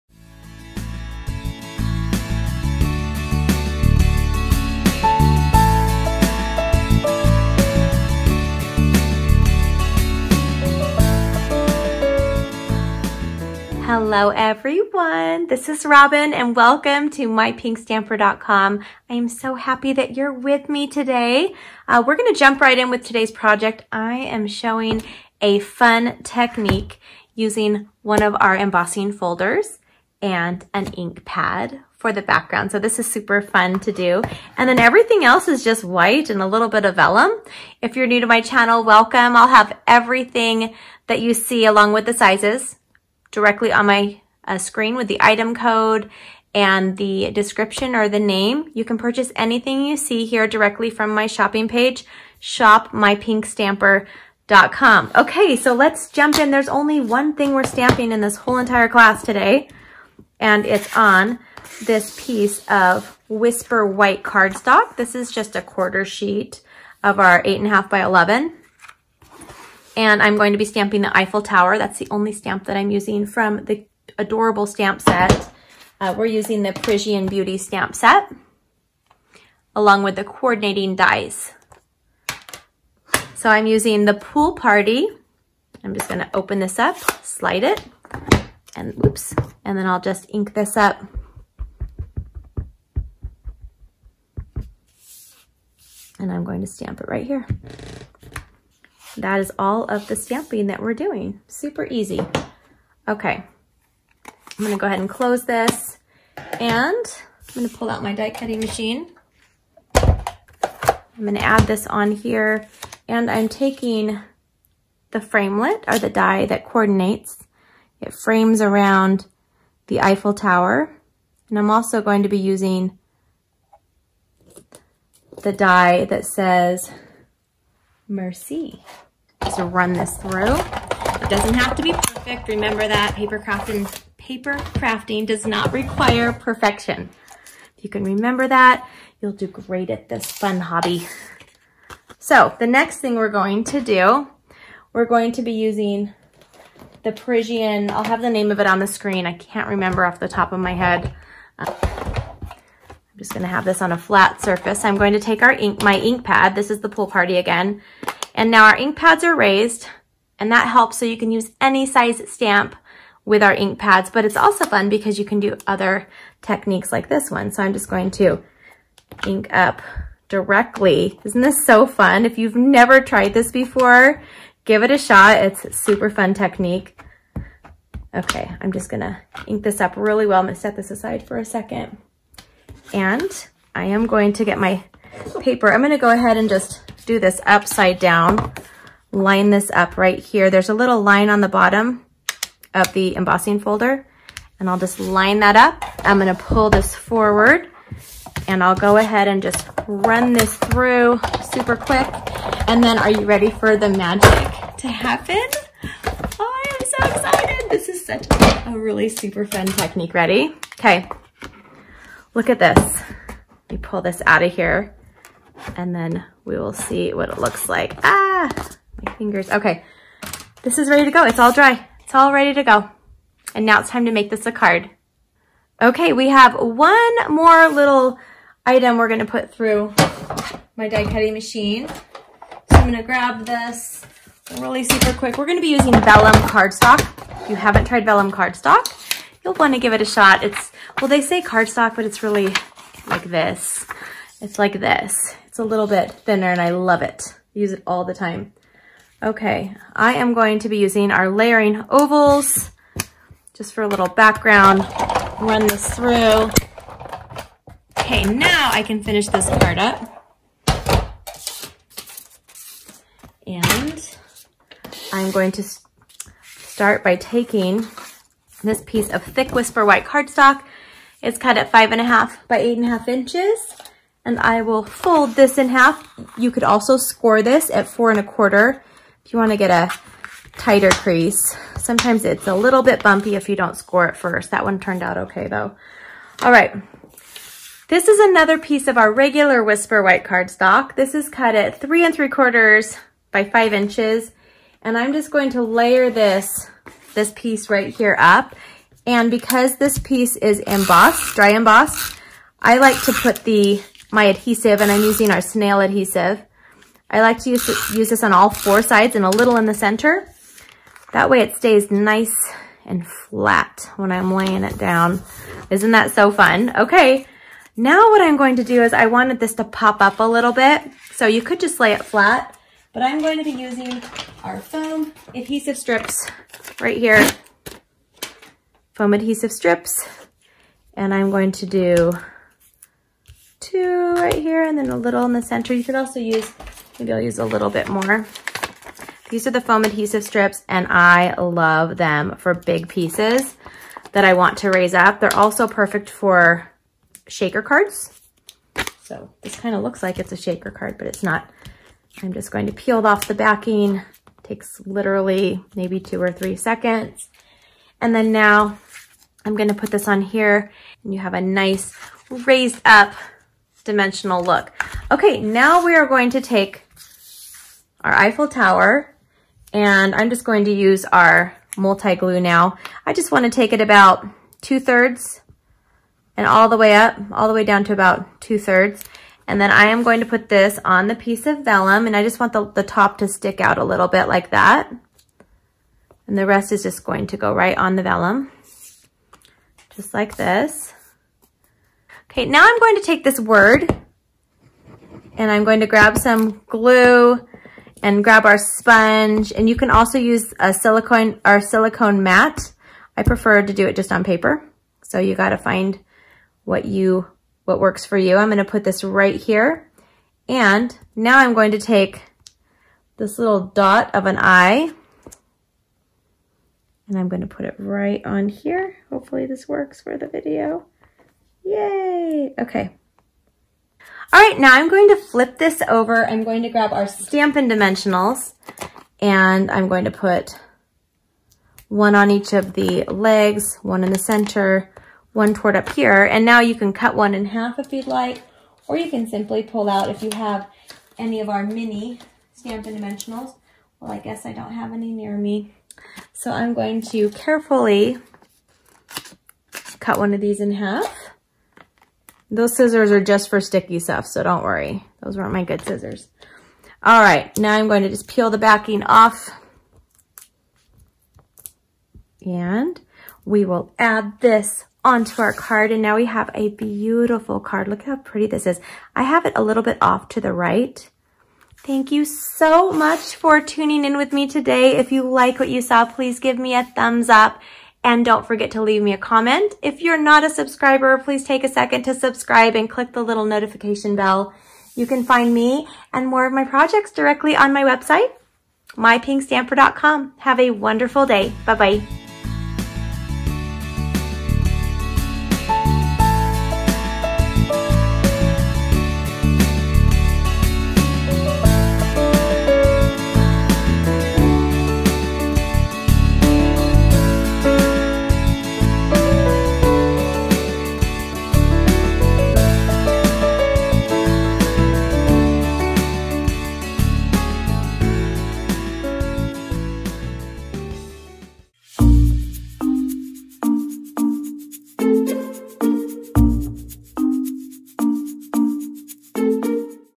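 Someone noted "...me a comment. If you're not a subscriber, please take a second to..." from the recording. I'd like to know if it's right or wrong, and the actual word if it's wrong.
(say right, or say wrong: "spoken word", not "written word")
right.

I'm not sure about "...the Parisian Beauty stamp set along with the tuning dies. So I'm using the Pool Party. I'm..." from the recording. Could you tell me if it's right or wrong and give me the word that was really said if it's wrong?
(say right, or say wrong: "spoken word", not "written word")
wrong: "coordinating", not "tuning".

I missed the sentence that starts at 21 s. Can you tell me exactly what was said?
Uh, we're going to jump right in with today's project.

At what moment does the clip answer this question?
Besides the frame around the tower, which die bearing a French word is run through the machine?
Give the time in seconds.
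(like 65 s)
128 s.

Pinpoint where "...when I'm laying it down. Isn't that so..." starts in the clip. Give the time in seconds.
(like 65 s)
313 s.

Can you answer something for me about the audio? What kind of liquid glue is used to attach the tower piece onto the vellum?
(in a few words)
multi-glue.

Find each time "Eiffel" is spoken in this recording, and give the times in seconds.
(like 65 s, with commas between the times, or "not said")
71 s, 119 s, 368 s.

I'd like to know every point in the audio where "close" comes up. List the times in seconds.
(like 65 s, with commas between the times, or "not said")
105 s.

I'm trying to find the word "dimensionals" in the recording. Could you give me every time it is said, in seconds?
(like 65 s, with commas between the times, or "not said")
363 s, 427 s, 442 s.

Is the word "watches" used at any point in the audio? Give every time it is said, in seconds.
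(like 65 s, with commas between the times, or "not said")
not said.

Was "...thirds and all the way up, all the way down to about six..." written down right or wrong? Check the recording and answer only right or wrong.
wrong.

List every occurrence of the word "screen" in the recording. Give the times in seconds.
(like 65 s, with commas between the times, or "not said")
44 s, 148 s.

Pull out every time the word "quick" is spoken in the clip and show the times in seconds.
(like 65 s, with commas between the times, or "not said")
201 s, 235 s.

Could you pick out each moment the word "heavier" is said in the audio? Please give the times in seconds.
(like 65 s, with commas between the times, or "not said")
not said.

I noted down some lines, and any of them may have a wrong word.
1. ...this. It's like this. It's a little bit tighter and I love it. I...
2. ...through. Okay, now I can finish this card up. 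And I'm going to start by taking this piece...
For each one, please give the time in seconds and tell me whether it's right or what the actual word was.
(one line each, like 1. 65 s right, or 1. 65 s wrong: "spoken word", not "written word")
1. 243 s wrong: "thinner", not "tighter"
2. 255 s right.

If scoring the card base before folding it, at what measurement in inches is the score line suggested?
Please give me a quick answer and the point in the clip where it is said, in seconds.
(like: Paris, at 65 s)
4 1/4, at 277 s.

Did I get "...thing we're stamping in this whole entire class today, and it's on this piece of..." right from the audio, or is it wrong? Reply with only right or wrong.
right.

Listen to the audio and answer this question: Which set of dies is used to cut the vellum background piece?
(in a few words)
layering ovals.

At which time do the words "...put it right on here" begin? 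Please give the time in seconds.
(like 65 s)
417 s.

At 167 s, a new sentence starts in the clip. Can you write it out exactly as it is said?
So I'm just going to ink up directly.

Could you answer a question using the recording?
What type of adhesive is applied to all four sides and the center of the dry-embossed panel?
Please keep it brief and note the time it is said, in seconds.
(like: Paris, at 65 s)
snail adhesive, at 305 s.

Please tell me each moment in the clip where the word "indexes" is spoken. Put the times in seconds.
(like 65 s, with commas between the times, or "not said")
not said.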